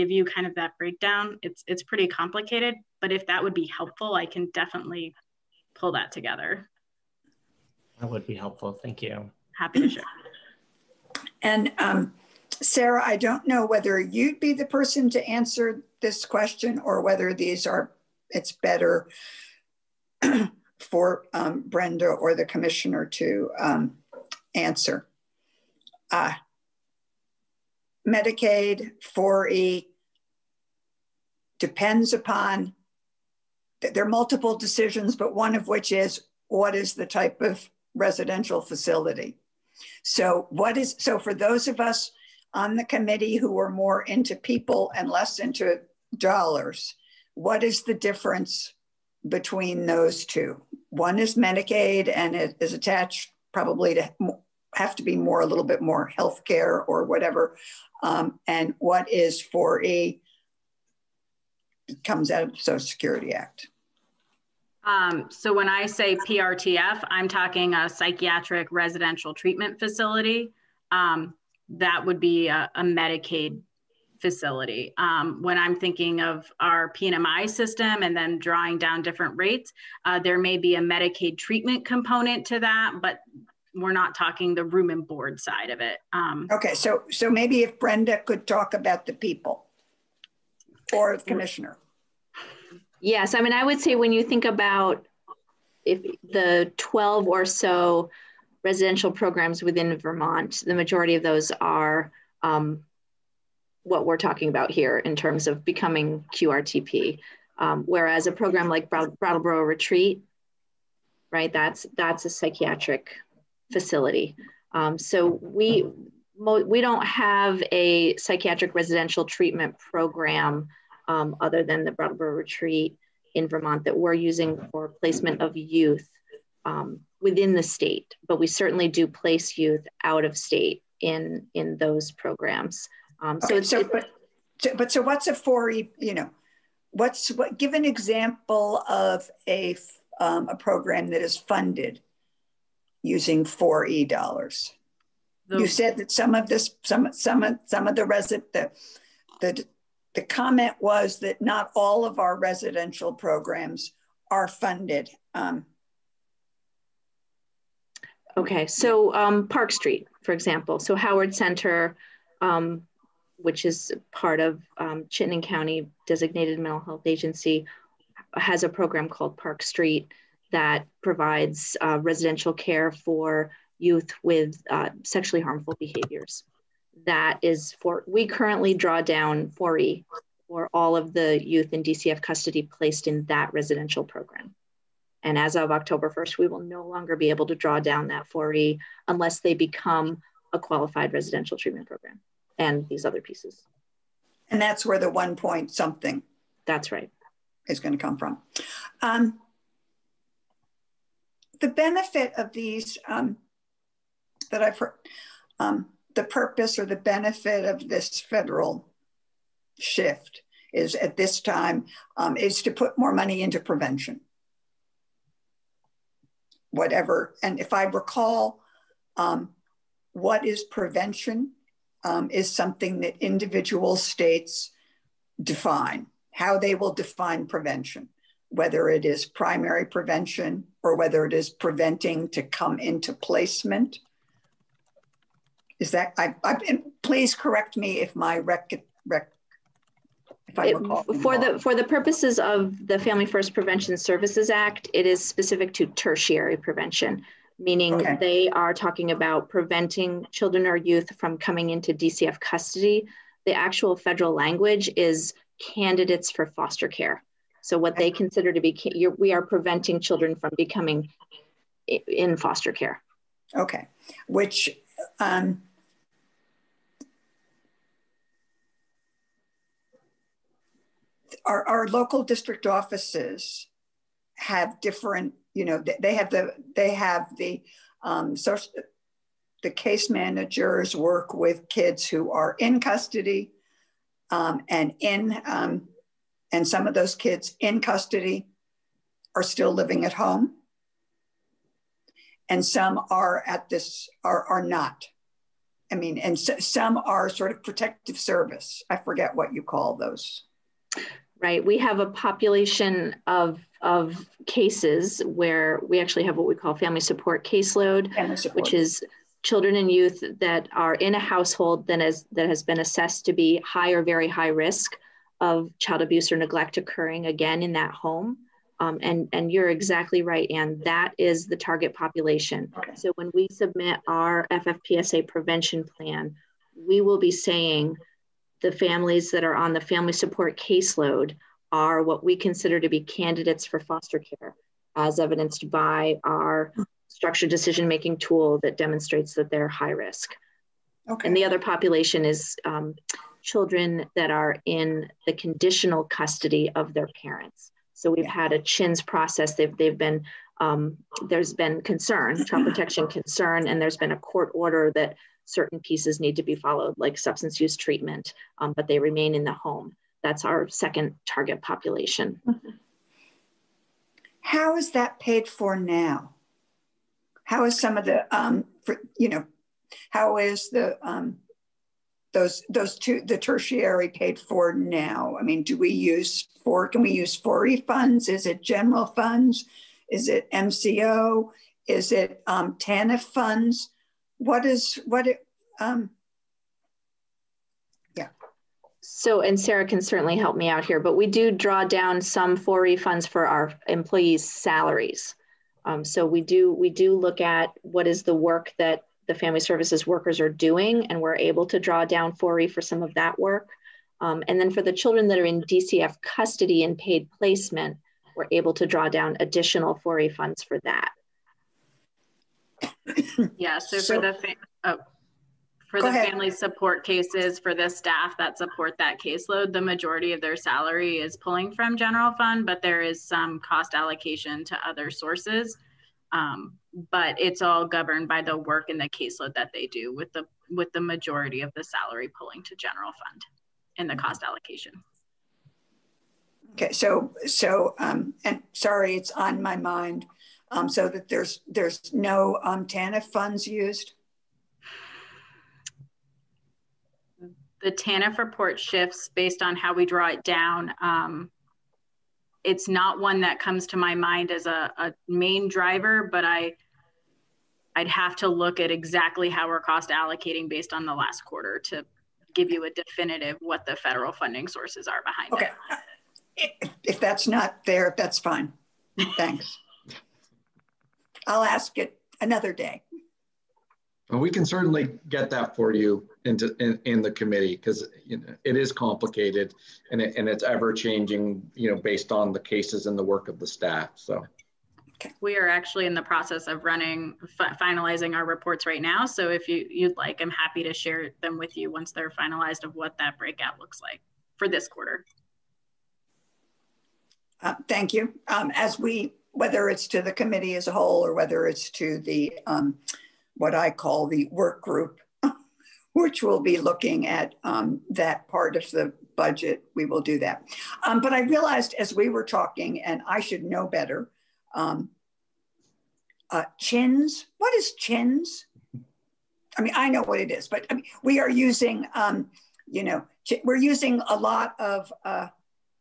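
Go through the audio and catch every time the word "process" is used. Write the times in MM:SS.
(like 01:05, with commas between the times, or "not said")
05:49, 08:06.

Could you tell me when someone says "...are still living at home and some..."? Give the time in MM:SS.
04:49.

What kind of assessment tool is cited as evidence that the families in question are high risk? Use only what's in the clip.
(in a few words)
structured decision making.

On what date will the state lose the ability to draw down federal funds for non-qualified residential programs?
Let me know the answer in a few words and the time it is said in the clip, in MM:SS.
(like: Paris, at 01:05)
October 1st, at 03:05.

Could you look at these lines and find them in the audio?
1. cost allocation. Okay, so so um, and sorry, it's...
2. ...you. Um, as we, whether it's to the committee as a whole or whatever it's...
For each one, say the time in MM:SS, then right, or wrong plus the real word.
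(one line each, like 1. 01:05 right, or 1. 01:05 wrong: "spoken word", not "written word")
1. 07:14 right
2. 08:18 wrong: "whether", not "whatever".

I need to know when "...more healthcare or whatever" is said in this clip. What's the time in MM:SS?
00:55.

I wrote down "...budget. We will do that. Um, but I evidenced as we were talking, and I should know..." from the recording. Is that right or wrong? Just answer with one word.
wrong.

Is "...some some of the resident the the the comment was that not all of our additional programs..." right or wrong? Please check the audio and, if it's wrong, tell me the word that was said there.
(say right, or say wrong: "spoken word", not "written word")
wrong: "residential", not "additional".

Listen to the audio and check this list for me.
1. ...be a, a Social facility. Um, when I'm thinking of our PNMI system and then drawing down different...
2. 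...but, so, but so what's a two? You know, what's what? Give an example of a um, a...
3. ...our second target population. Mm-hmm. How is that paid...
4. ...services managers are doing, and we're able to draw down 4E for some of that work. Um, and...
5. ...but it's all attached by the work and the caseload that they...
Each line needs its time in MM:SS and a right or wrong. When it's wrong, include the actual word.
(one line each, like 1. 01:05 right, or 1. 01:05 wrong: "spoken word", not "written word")
1. 01:12 wrong: "Medicaid", not "Social"
2. 02:13 wrong: "four", not "two"
3. 06:00 right
4. 06:39 wrong: "workers", not "managers"
5. 07:07 wrong: "governed", not "attached".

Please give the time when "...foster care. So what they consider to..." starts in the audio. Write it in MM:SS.
04:16.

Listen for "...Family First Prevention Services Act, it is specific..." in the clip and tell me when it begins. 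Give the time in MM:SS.
04:02.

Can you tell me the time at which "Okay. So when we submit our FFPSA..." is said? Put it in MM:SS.
05:22.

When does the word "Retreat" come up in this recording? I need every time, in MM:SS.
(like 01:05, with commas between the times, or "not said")
01:49, 02:02.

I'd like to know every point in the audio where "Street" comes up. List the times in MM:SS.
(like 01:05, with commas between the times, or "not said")
02:39, 02:49.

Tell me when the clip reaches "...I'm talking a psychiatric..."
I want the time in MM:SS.
01:07.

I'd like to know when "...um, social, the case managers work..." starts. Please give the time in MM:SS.
04:38.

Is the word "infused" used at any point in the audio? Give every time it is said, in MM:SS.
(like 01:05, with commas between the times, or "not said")
not said.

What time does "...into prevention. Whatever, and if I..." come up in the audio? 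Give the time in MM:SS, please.
03:33.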